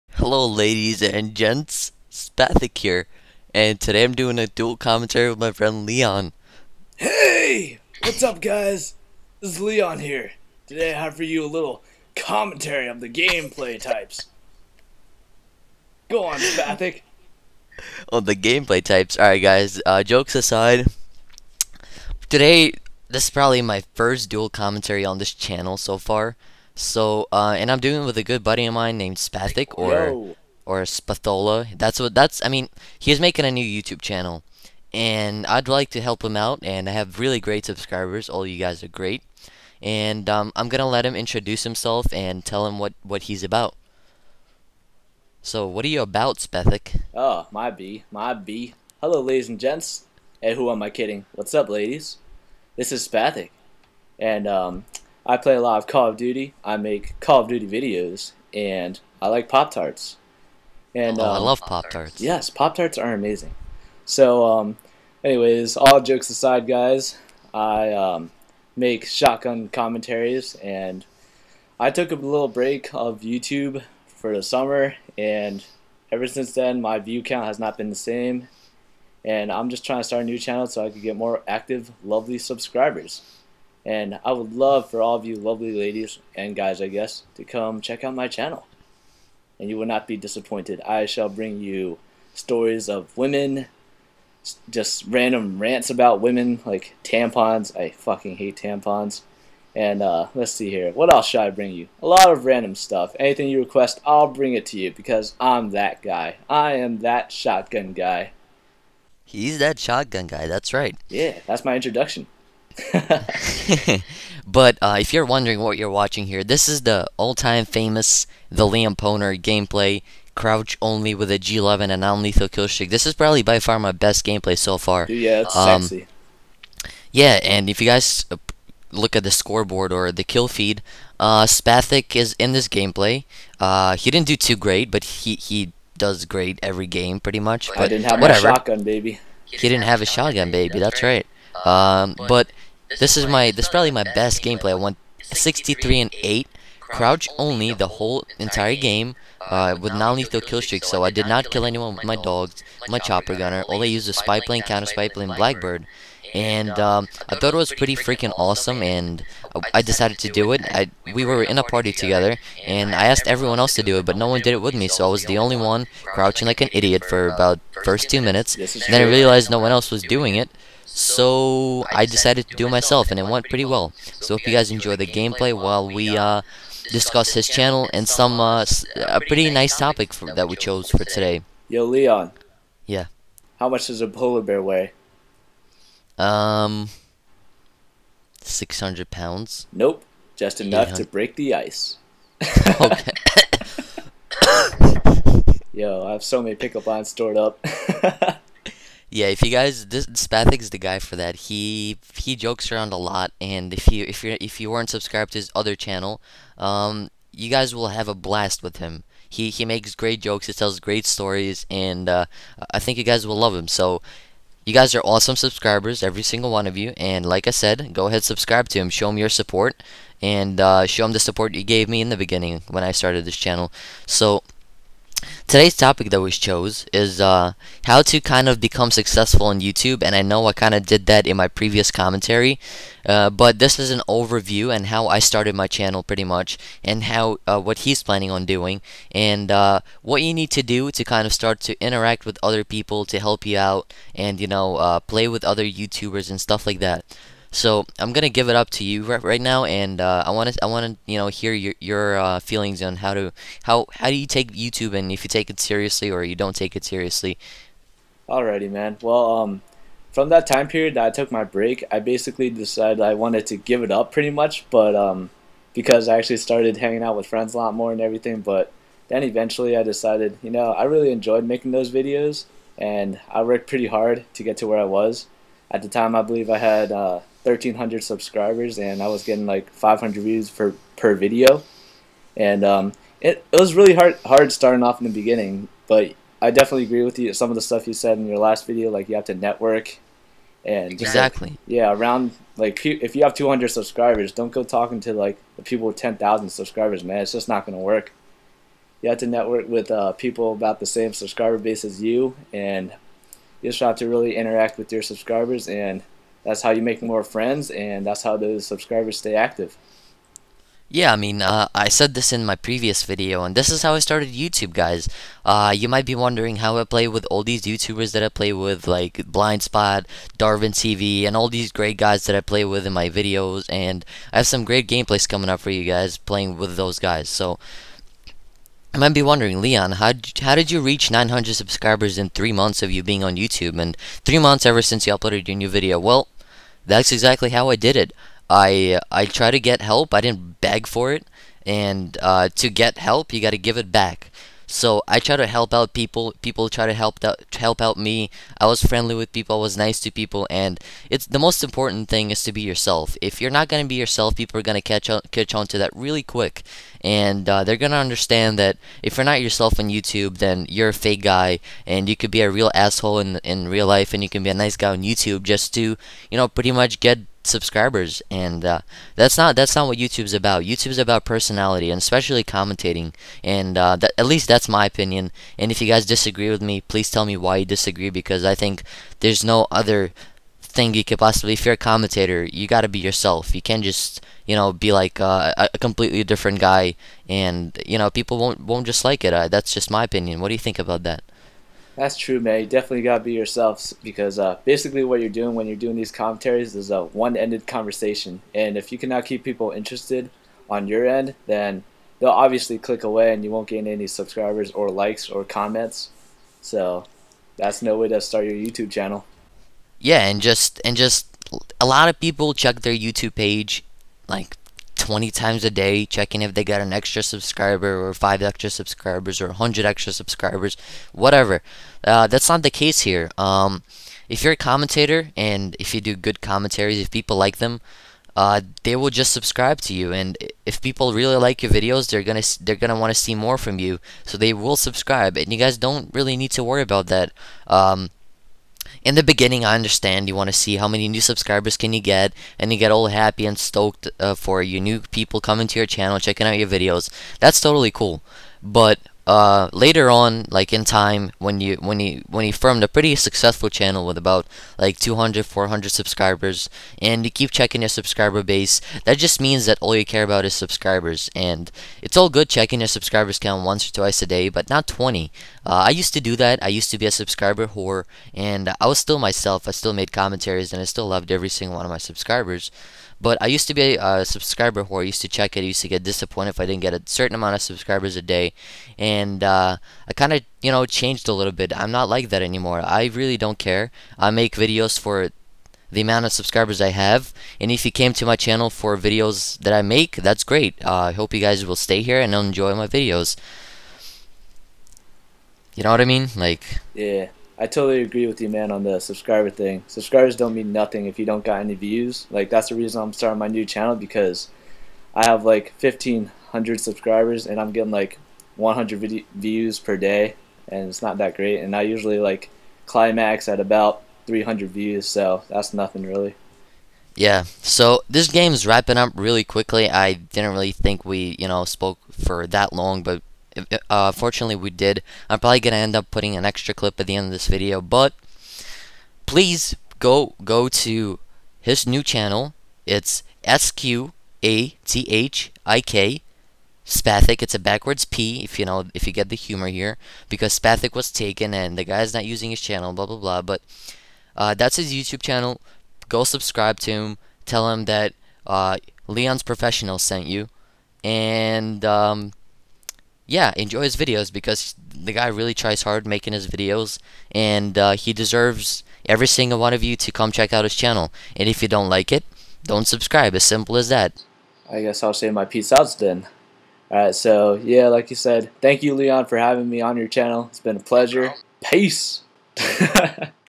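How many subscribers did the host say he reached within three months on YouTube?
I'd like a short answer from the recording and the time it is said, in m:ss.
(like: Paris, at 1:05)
900, at 5:31.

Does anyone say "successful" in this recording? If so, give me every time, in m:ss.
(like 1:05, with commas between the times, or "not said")
3:48, 7:33.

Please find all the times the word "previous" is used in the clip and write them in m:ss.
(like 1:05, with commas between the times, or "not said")
3:51, 5:12.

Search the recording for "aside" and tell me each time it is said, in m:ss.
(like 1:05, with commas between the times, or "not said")
0:20, 1:06.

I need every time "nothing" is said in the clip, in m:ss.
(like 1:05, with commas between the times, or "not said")
8:20, 8:35.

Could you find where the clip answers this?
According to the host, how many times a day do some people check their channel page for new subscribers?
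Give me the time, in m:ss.
6:55.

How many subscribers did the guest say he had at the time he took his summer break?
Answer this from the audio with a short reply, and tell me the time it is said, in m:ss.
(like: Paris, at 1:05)
1,300, at 4:37.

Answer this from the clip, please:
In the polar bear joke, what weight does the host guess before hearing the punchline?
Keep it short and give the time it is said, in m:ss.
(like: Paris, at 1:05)
600 pounds, at 3:08.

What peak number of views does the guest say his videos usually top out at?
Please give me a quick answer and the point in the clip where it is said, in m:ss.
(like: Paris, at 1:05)
300, at 8:34.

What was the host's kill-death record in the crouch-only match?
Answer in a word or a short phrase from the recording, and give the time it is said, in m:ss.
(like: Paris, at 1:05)
63 and 8, at 2:25.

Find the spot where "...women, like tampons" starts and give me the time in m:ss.
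1:36.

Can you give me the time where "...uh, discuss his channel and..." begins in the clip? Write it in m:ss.
2:56.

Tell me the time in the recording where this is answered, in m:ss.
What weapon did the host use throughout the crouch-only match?
2:01.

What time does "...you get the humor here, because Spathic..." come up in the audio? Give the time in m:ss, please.
8:59.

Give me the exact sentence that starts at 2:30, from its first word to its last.
So I did not kill anyone with my dogs, my chopper gunner.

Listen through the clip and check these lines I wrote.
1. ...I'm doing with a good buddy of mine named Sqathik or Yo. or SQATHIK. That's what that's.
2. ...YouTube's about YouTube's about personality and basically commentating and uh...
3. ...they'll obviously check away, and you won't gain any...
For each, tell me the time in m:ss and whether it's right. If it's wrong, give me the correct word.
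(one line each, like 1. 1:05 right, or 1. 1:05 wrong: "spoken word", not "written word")
1. 0:27 wrong: "Spathola", not "SQATHIK"
2. 6:09 wrong: "especially", not "basically"
3. 6:42 wrong: "click", not "check".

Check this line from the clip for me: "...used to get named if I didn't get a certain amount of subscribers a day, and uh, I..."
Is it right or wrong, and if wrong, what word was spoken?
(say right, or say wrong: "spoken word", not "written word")
wrong: "disappointed", not "named".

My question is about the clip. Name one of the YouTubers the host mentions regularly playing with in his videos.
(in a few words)
Blind Spot.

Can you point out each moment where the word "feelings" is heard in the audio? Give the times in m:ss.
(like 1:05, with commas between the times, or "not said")
4:12.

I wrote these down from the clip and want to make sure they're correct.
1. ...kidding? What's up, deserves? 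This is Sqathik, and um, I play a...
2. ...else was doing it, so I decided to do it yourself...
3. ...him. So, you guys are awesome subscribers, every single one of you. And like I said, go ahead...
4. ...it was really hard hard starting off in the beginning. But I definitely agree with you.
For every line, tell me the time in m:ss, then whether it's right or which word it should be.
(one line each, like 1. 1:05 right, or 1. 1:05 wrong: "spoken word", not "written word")
1. 0:50 wrong: "ladies", not "deserves"
2. 2:49 wrong: "myself", not "yourself"
3. 3:33 right
4. 4:43 right.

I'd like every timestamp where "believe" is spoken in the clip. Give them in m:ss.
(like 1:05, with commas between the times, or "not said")
4:36.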